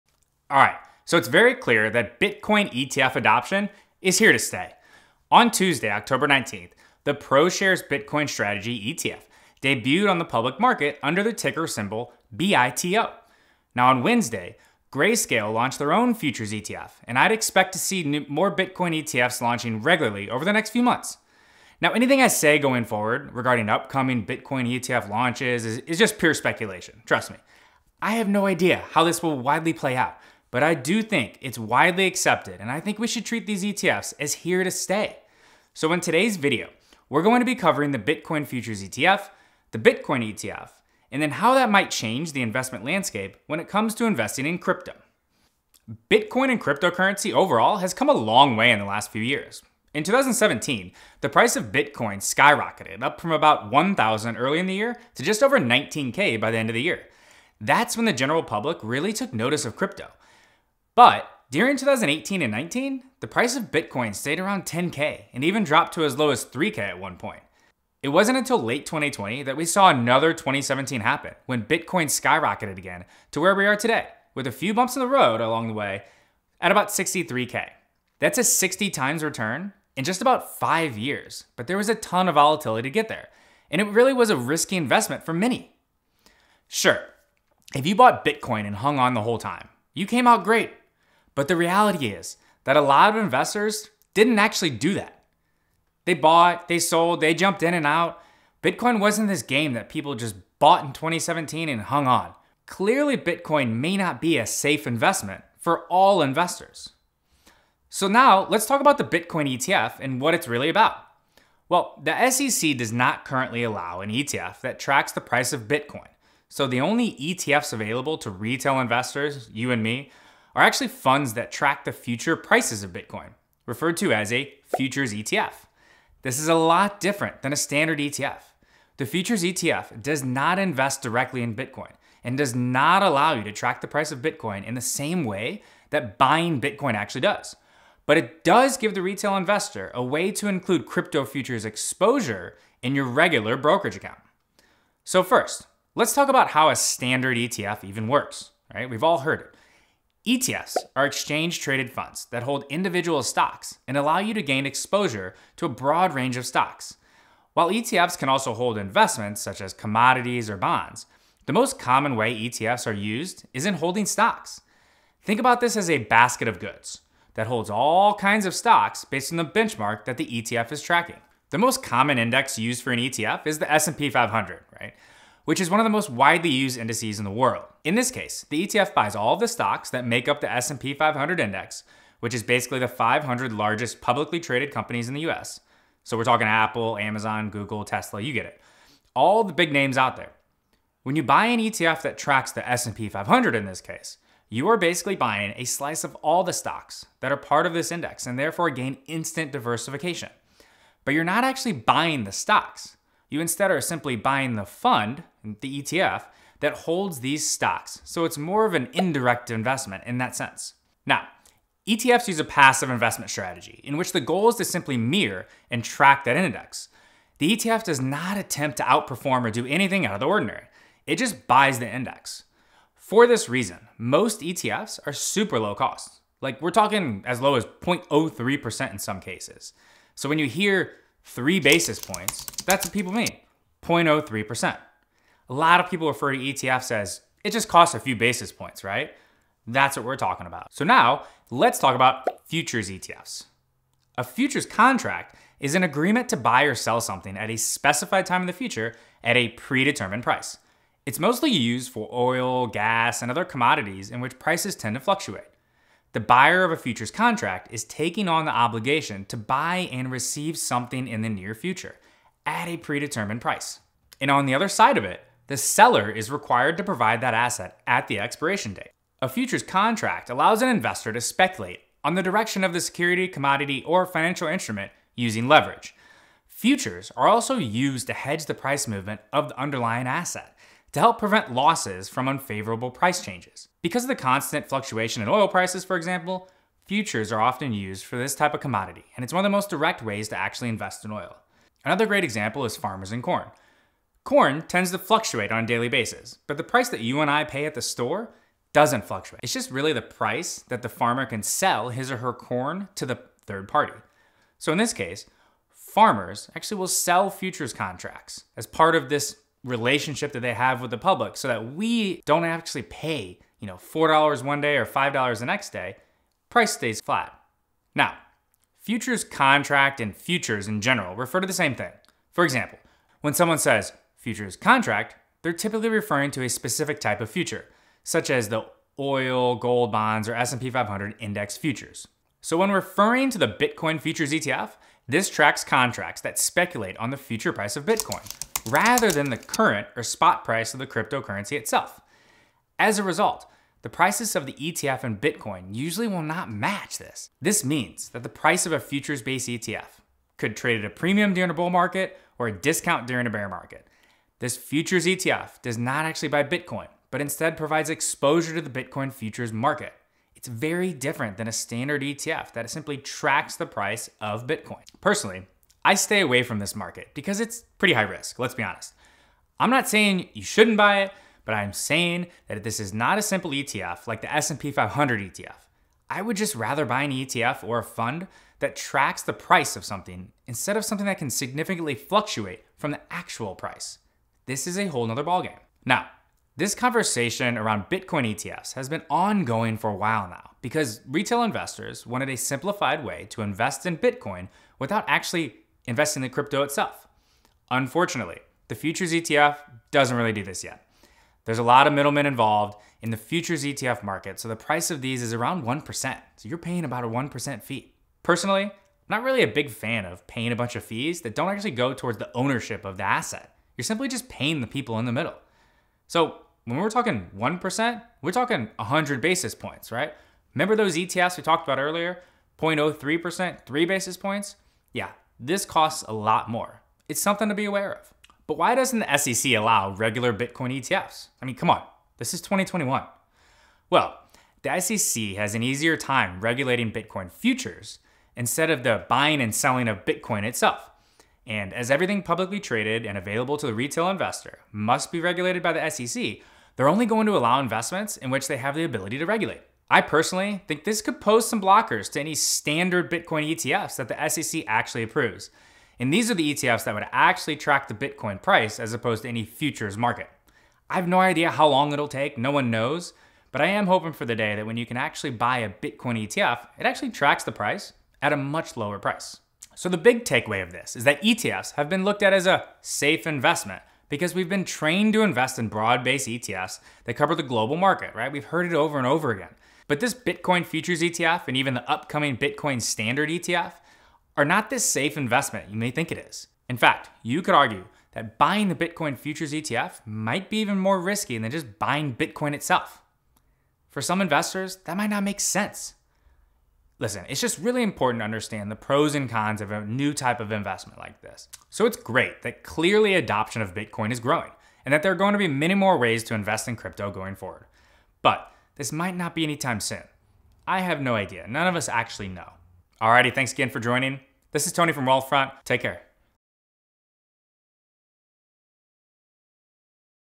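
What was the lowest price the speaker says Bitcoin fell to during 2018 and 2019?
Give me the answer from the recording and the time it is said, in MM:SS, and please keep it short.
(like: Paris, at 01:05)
3K, at 01:06.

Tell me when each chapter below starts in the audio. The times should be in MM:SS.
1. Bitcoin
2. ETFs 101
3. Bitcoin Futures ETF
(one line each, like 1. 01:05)
1. 00:45
2. 02:30
3. 04:00.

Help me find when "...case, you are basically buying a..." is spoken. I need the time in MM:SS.
03:13.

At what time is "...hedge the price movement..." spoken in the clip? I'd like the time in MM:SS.
04:38.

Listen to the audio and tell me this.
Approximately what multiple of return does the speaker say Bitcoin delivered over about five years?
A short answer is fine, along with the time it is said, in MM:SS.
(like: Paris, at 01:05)
60 times, at 01:18.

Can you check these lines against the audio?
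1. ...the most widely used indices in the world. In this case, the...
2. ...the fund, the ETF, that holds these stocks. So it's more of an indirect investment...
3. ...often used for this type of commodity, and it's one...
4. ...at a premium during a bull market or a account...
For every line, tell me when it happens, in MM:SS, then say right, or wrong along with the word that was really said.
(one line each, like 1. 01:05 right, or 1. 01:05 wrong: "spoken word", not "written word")
1. 02:55 right
2. 03:24 right
3. 04:47 right
4. 05:50 wrong: "discount", not "account".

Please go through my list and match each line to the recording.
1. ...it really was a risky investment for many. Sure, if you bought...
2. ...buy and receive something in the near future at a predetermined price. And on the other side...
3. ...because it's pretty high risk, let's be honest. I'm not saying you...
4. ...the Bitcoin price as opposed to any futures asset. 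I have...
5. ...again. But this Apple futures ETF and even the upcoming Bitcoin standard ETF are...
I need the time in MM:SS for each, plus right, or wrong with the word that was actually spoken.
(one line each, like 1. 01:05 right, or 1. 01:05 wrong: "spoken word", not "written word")
1. 01:23 right
2. 04:19 right
3. 06:07 right
4. 07:37 wrong: "market", not "asset"
5. 07:59 wrong: "Bitcoin", not "Apple".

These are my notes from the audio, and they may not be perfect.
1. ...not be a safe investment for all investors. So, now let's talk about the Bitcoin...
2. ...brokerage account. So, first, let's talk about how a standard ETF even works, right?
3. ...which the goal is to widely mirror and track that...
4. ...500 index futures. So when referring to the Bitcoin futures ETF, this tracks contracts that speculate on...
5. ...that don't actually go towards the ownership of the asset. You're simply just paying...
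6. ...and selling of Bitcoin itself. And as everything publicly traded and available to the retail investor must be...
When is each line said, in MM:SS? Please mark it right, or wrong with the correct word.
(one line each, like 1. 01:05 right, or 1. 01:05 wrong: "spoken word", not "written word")
1. 01:43 right
2. 02:23 right
3. 03:33 wrong: "simply", not "widely"
4. 05:30 right
5. 06:51 right
6. 07:19 right.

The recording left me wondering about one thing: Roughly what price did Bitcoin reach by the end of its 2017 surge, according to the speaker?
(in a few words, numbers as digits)
just over 19K.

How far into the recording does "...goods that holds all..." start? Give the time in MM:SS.
02:46.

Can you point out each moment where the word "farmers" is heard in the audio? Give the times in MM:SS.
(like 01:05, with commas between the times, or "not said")
04:52, 05:00, 05:05.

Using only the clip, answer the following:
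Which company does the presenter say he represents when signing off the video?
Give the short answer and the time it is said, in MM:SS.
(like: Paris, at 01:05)
Wealthfront, at 08:35.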